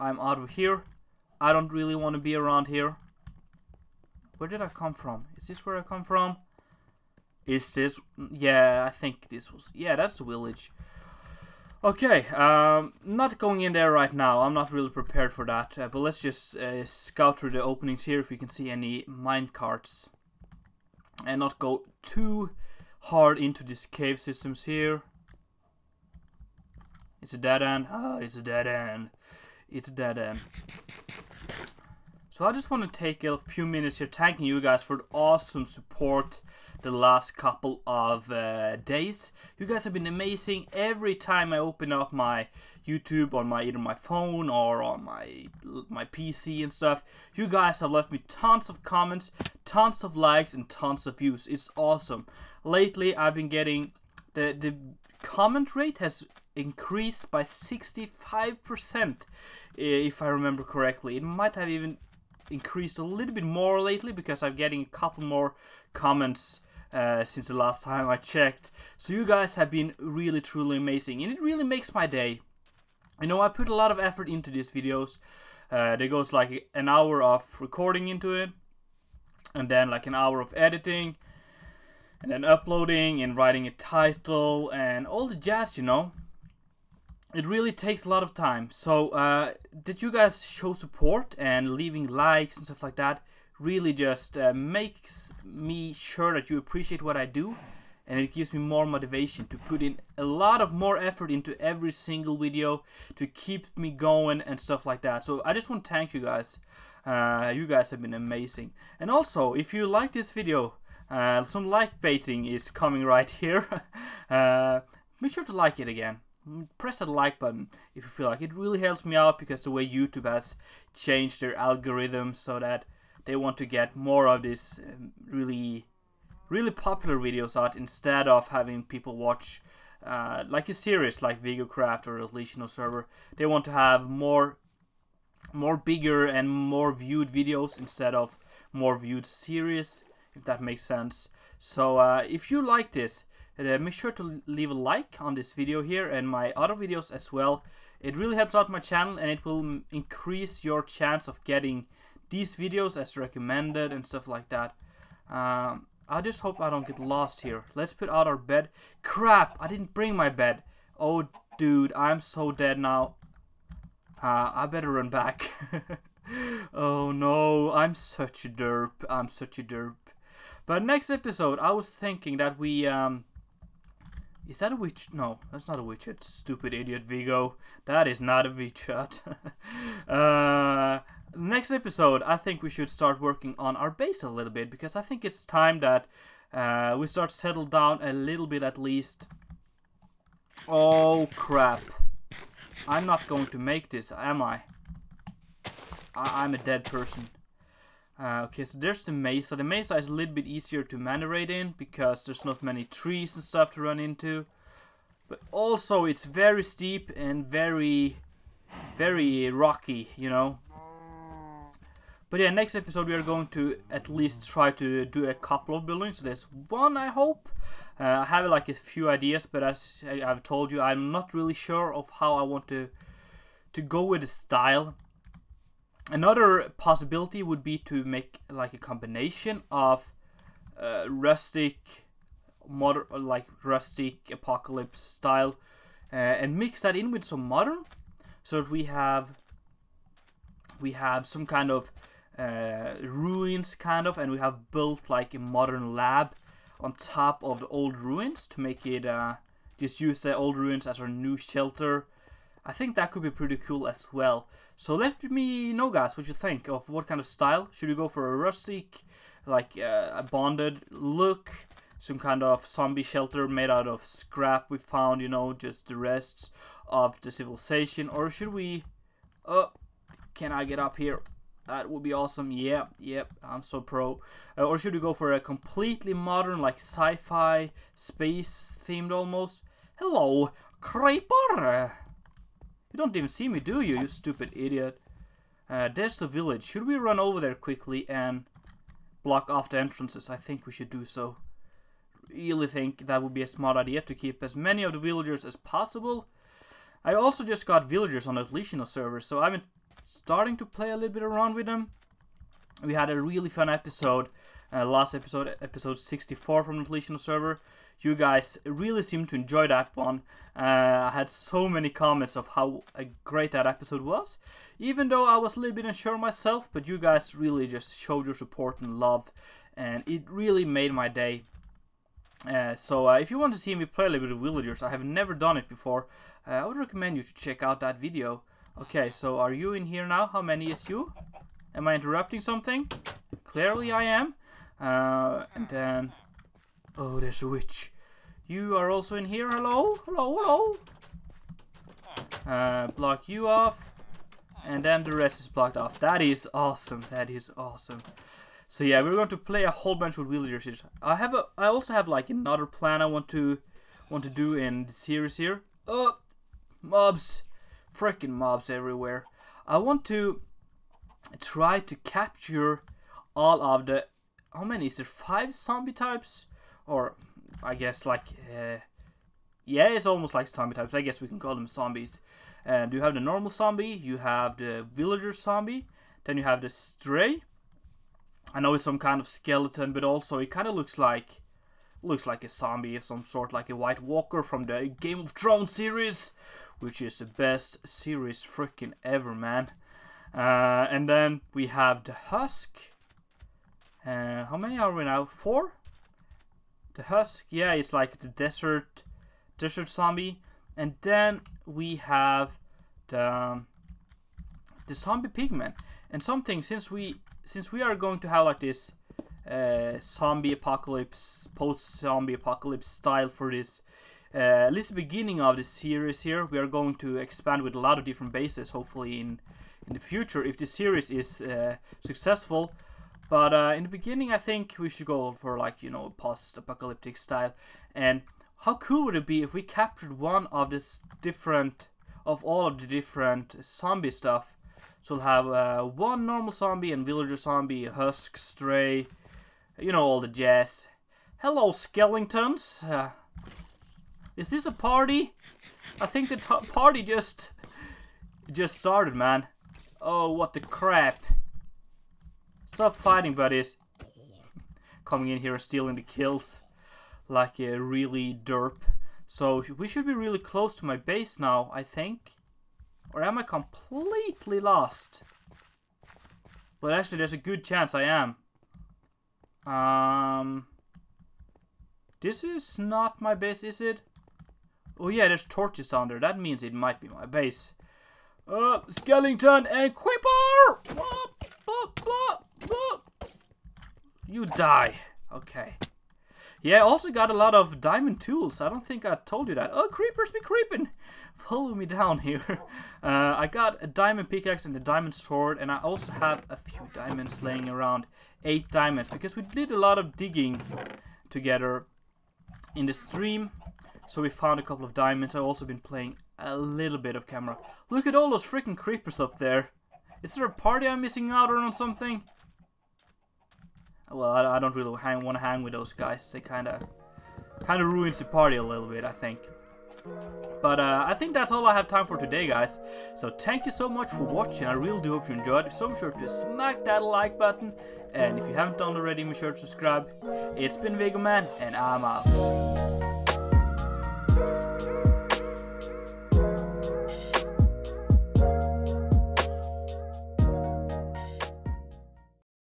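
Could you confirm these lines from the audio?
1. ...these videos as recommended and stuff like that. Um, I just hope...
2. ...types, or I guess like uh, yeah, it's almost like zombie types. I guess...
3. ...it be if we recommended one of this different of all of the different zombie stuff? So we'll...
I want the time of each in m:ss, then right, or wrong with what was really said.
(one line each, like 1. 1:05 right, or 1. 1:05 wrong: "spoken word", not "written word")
1. 2:32 right
2. 6:05 right
3. 7:09 wrong: "captured", not "recommended".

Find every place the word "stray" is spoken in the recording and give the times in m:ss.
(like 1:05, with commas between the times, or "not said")
6:16, 7:18.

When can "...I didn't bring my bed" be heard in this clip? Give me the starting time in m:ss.
2:39.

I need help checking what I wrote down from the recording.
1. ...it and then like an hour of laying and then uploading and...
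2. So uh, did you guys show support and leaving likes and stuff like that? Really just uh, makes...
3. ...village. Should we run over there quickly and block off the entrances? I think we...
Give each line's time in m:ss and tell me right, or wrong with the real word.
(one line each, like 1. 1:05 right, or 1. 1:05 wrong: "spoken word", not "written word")
1. 1:18 wrong: "editing", not "laying"
2. 1:28 right
3. 4:46 right.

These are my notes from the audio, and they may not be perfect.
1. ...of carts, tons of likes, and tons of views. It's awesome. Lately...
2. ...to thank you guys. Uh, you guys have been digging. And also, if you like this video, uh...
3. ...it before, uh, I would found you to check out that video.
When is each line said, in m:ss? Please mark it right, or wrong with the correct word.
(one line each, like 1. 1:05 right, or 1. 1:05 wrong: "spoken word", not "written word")
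1. 0:48 wrong: "comments", not "carts"
2. 1:45 wrong: "amazing", not "digging"
3. 5:25 wrong: "recommend", not "found".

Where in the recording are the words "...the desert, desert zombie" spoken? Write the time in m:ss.
6:38.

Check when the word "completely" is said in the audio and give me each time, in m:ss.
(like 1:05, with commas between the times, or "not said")
4:35, 7:43.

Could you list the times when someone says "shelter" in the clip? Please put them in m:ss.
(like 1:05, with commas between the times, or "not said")
4:11, 4:23.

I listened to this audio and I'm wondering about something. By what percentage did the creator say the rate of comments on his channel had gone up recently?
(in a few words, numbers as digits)
65%.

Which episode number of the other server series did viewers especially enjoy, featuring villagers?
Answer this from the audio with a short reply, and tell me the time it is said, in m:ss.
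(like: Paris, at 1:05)
64, at 5:05.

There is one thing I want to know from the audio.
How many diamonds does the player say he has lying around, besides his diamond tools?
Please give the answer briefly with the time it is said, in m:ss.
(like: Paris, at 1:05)
8, at 8:18.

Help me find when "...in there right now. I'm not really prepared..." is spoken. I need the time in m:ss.
0:13.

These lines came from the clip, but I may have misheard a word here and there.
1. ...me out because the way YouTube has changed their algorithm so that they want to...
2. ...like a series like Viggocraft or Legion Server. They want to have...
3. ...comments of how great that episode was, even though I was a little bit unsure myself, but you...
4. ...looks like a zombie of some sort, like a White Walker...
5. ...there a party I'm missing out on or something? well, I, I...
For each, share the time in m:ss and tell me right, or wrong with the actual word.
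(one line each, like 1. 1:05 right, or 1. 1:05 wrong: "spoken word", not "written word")
1. 1:59 right
2. 2:10 right
3. 5:11 right
4. 6:22 right
5. 8:30 right.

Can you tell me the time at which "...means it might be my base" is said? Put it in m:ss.
7:56.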